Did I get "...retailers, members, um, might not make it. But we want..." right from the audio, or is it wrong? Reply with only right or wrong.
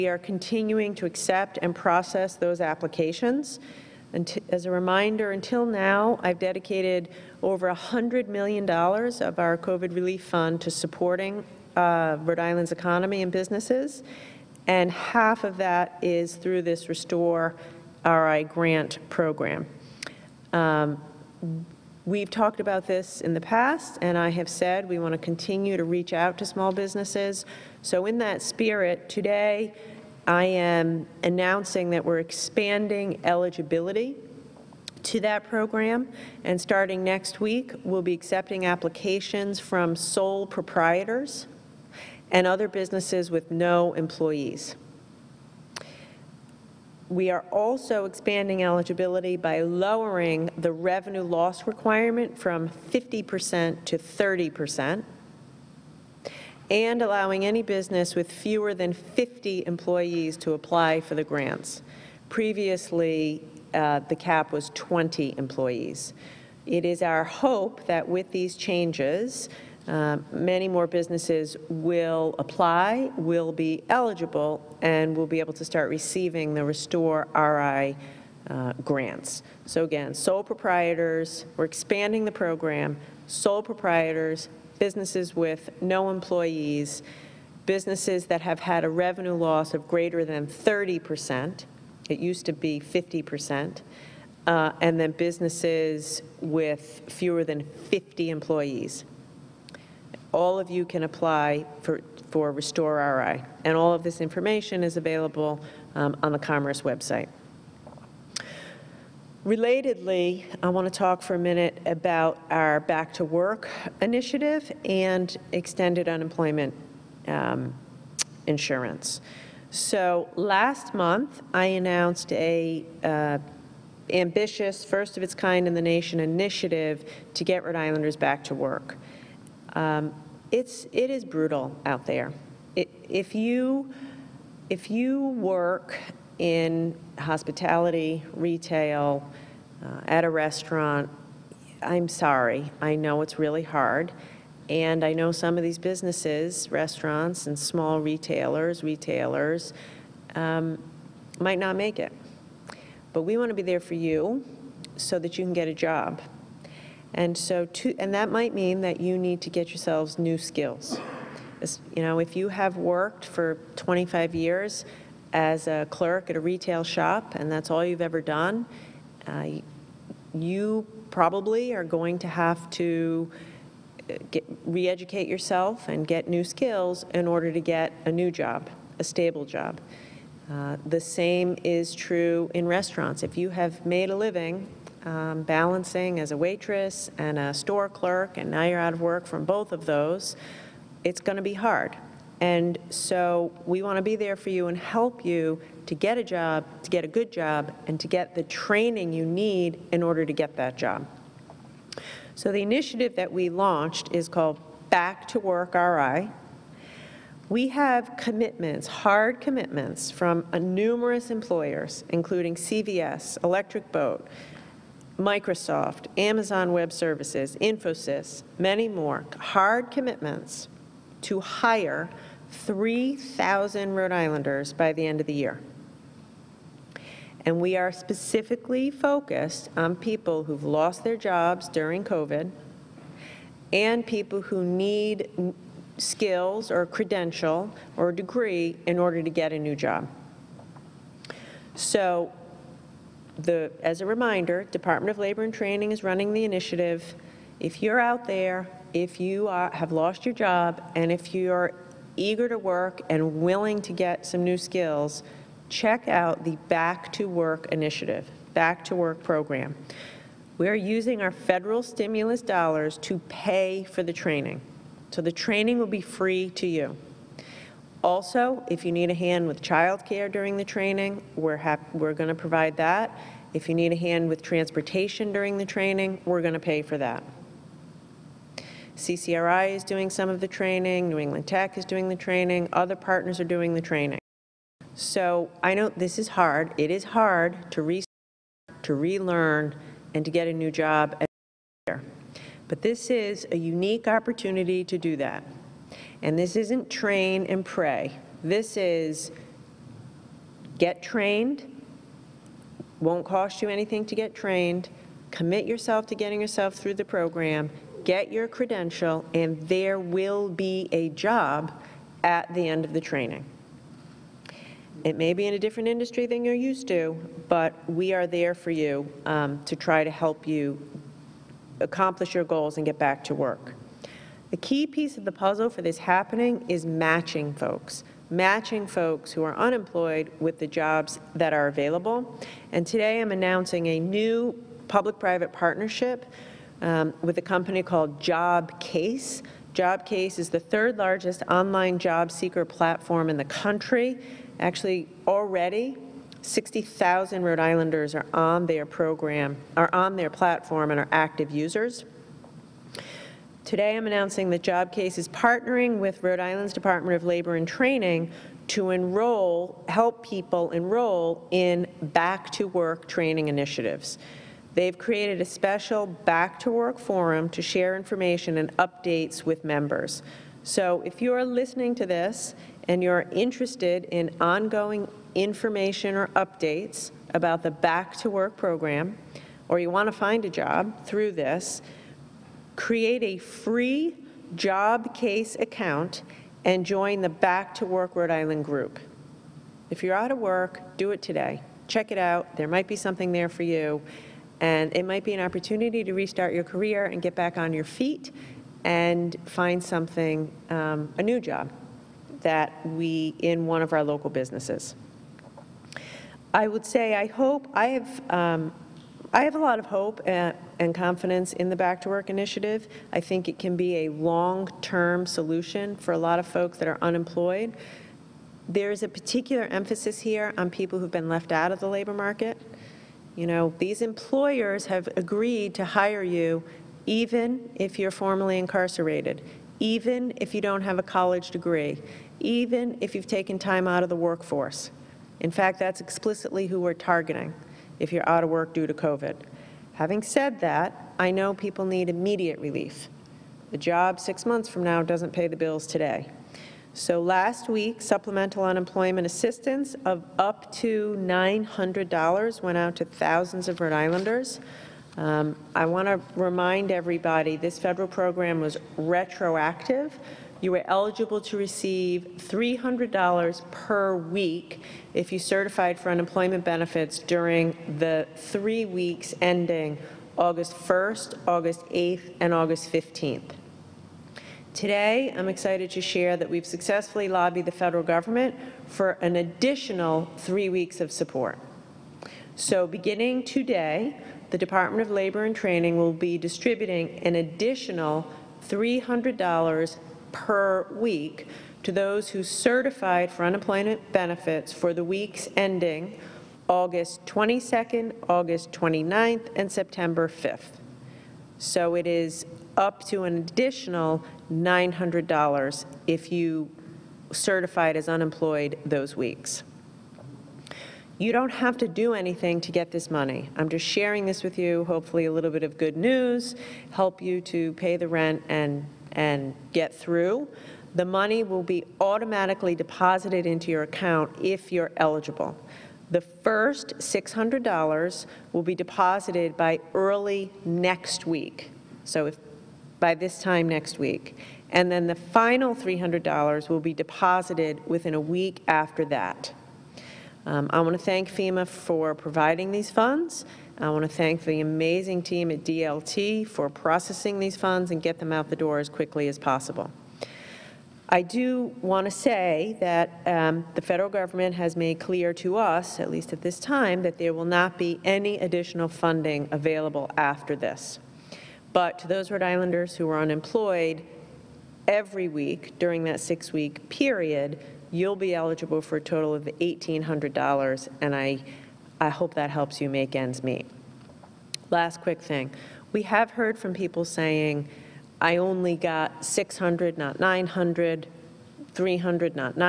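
wrong.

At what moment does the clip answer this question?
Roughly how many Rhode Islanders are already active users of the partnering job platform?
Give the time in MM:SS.
05:46.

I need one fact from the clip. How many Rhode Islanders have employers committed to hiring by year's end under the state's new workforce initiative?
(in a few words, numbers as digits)
3,000.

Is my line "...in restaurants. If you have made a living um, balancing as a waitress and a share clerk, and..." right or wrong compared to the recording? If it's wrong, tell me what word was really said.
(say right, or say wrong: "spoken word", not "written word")
wrong: "store", not "share".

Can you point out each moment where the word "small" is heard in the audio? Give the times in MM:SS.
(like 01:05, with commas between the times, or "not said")
00:26, 02:27.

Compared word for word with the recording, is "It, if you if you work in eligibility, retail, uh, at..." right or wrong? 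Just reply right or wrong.
wrong.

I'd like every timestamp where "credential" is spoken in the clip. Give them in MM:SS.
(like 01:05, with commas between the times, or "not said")
03:56, 05:08.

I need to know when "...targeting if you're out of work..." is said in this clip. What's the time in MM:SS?
07:16.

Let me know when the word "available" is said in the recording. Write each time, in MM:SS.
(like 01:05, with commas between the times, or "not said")
01:44, 05:31, 09:19.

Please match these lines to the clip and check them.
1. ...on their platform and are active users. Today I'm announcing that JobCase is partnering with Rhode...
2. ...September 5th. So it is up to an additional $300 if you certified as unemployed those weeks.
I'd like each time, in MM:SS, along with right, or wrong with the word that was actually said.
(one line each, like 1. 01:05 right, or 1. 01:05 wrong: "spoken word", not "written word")
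1. 05:49 right
2. 08:19 wrong: "900", not "300".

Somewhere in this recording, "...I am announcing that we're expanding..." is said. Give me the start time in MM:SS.
00:30.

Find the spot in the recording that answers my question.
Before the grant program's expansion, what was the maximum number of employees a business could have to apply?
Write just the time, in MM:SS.
01:04.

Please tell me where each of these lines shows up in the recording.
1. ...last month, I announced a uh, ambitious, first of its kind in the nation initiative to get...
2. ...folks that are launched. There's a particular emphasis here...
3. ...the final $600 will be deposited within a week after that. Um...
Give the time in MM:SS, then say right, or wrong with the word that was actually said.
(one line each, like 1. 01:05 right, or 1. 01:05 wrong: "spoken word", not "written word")
1. 02:00 right
2. 06:56 wrong: "unemployed", not "launched"
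3. 08:55 wrong: "300", not "600".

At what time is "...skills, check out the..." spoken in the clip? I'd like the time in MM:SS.
04:14.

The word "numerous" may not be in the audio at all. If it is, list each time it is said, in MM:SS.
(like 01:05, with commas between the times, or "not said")
03:30.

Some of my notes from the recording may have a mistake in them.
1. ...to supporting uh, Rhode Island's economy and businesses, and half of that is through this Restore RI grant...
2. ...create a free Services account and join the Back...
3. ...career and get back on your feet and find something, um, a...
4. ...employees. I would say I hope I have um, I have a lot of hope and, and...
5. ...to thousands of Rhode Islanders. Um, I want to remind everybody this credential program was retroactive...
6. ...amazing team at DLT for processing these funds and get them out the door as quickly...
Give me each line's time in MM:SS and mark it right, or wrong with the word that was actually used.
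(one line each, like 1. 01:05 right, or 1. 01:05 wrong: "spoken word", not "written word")
1. 00:10 right
2. 06:22 wrong: "JobCase", not "Services"
3. 06:36 right
4. 06:44 wrong: "businesses", not "employees"
5. 07:32 wrong: "federal", not "credential"
6. 09:04 right.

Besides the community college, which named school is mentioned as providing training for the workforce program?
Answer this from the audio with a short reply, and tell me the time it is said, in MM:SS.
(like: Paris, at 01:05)
New England Tech, at 04:41.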